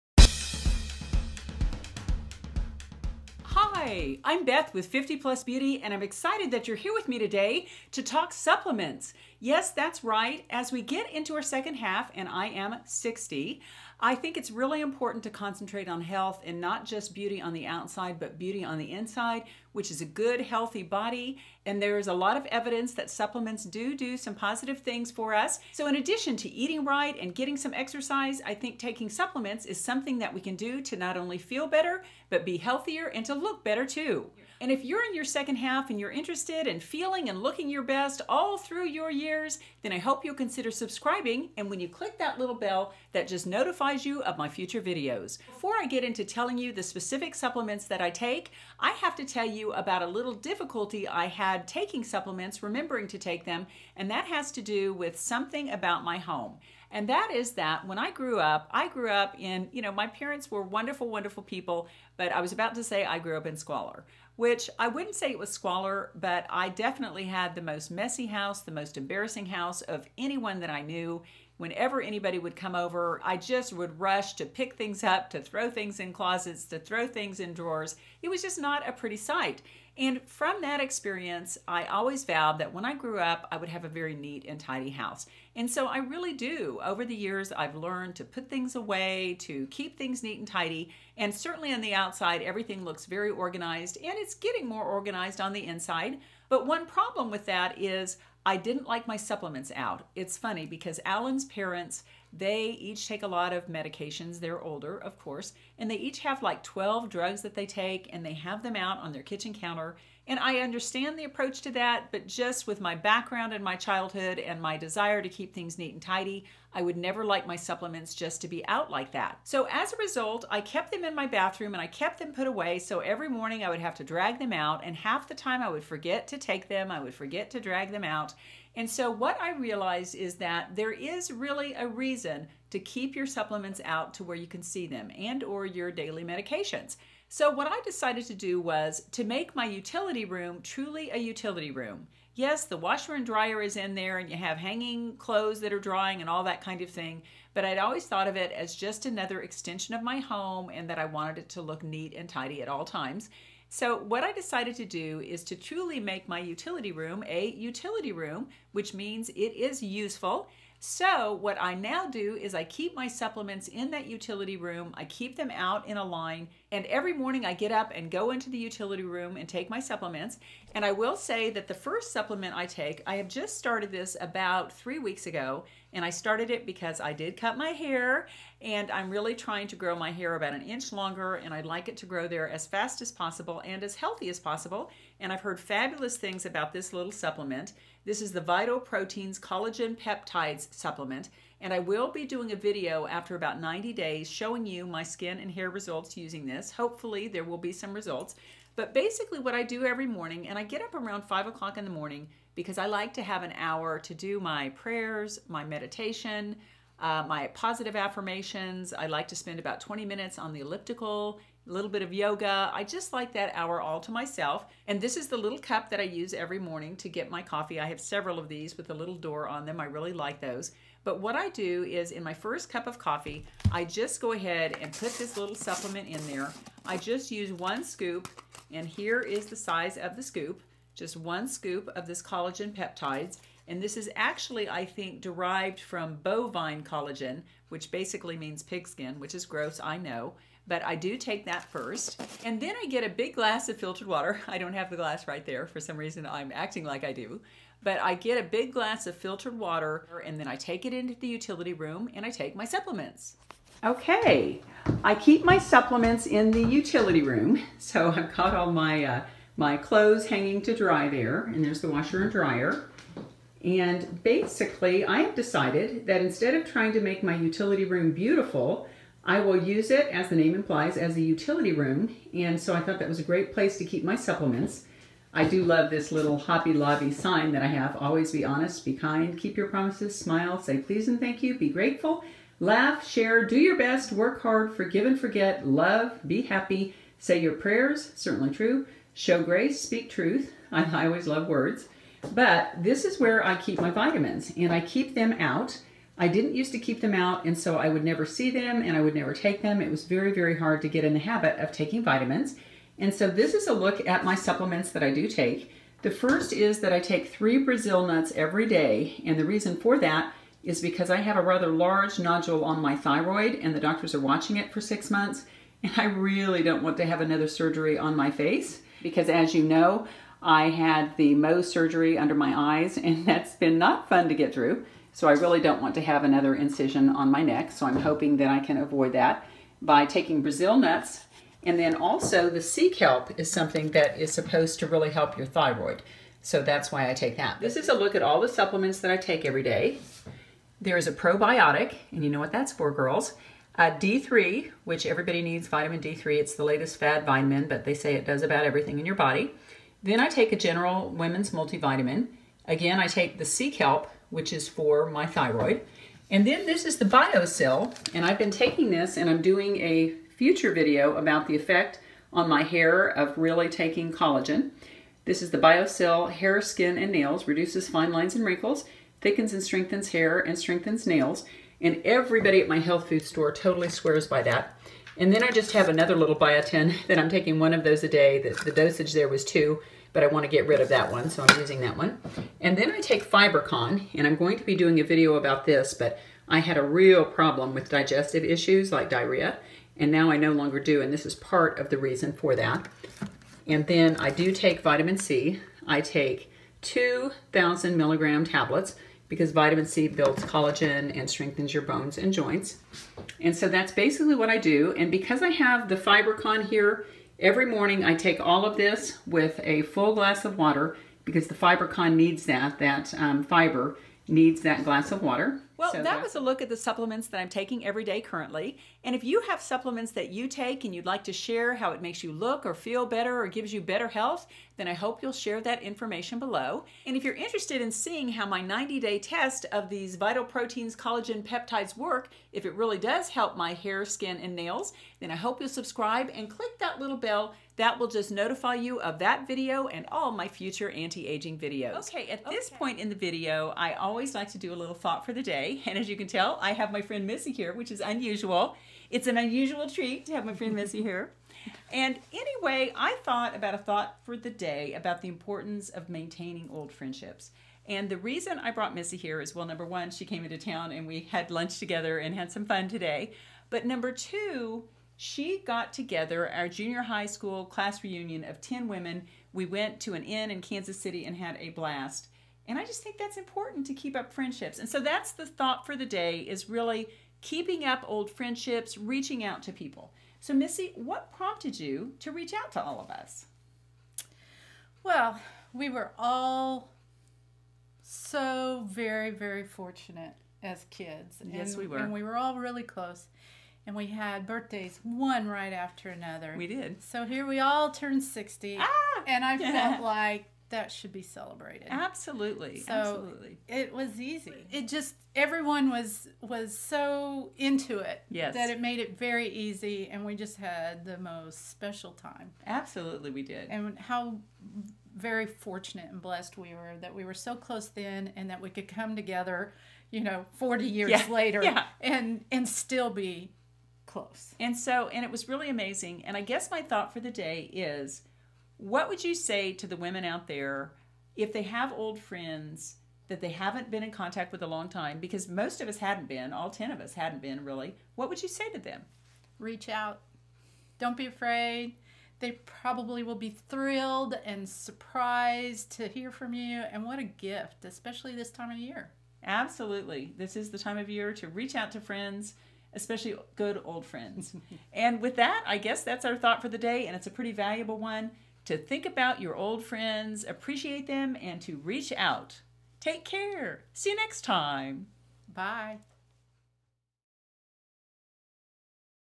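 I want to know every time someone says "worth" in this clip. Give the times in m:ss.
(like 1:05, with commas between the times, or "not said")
not said.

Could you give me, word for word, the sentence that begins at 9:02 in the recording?
They probably will be thrilled and surprised to hear from you.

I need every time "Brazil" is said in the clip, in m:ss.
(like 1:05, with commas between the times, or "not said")
5:07, 5:30.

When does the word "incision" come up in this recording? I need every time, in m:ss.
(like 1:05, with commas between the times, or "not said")
5:26.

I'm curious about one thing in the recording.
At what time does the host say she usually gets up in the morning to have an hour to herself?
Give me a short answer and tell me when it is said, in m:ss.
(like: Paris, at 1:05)
5 o'clock, at 3:21.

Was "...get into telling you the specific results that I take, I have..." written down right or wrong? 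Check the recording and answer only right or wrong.
wrong.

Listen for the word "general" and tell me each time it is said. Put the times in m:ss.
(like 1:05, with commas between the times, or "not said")
5:50.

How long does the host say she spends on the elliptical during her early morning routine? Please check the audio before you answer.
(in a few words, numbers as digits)
20 minutes.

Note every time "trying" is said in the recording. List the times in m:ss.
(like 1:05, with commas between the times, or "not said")
2:59, 4:26.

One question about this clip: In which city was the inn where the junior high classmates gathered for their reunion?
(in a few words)
Kansas City.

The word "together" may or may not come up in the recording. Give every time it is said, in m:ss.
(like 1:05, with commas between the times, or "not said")
7:41, 7:45, 8:39.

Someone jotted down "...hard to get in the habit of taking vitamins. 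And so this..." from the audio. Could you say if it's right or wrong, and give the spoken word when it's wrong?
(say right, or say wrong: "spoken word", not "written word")
right.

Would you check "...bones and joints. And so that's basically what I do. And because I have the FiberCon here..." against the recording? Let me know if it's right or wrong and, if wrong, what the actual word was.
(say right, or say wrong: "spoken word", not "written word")
right.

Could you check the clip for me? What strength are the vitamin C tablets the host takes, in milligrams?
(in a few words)
2,000 milligrams.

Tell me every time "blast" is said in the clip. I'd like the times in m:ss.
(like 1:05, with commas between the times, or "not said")
7:51.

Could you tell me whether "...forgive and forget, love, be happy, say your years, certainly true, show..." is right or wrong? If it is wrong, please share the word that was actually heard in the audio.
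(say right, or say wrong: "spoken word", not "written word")
wrong: "prayers", not "years".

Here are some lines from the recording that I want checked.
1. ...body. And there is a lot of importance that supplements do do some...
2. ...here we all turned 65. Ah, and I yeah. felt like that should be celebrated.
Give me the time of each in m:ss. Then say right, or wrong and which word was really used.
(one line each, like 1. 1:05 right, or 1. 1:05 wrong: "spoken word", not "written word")
1. 0:20 wrong: "evidence", not "importance"
2. 8:17 wrong: "60", not "65".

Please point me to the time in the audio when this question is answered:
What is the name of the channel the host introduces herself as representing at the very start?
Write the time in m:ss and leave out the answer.
0:04.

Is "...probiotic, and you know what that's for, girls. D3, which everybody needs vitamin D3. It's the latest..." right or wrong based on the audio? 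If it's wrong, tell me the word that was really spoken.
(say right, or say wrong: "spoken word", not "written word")
right.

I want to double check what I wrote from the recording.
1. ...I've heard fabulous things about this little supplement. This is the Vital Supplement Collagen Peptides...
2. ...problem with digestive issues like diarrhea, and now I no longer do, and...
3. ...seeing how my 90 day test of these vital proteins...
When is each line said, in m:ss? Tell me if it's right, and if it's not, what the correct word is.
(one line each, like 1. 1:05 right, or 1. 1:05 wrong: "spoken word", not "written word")
1. 3:05 wrong: "Proteins", not "Supplement"
2. 6:27 right
3. 7:07 right.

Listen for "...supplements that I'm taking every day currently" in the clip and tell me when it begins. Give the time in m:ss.
6:56.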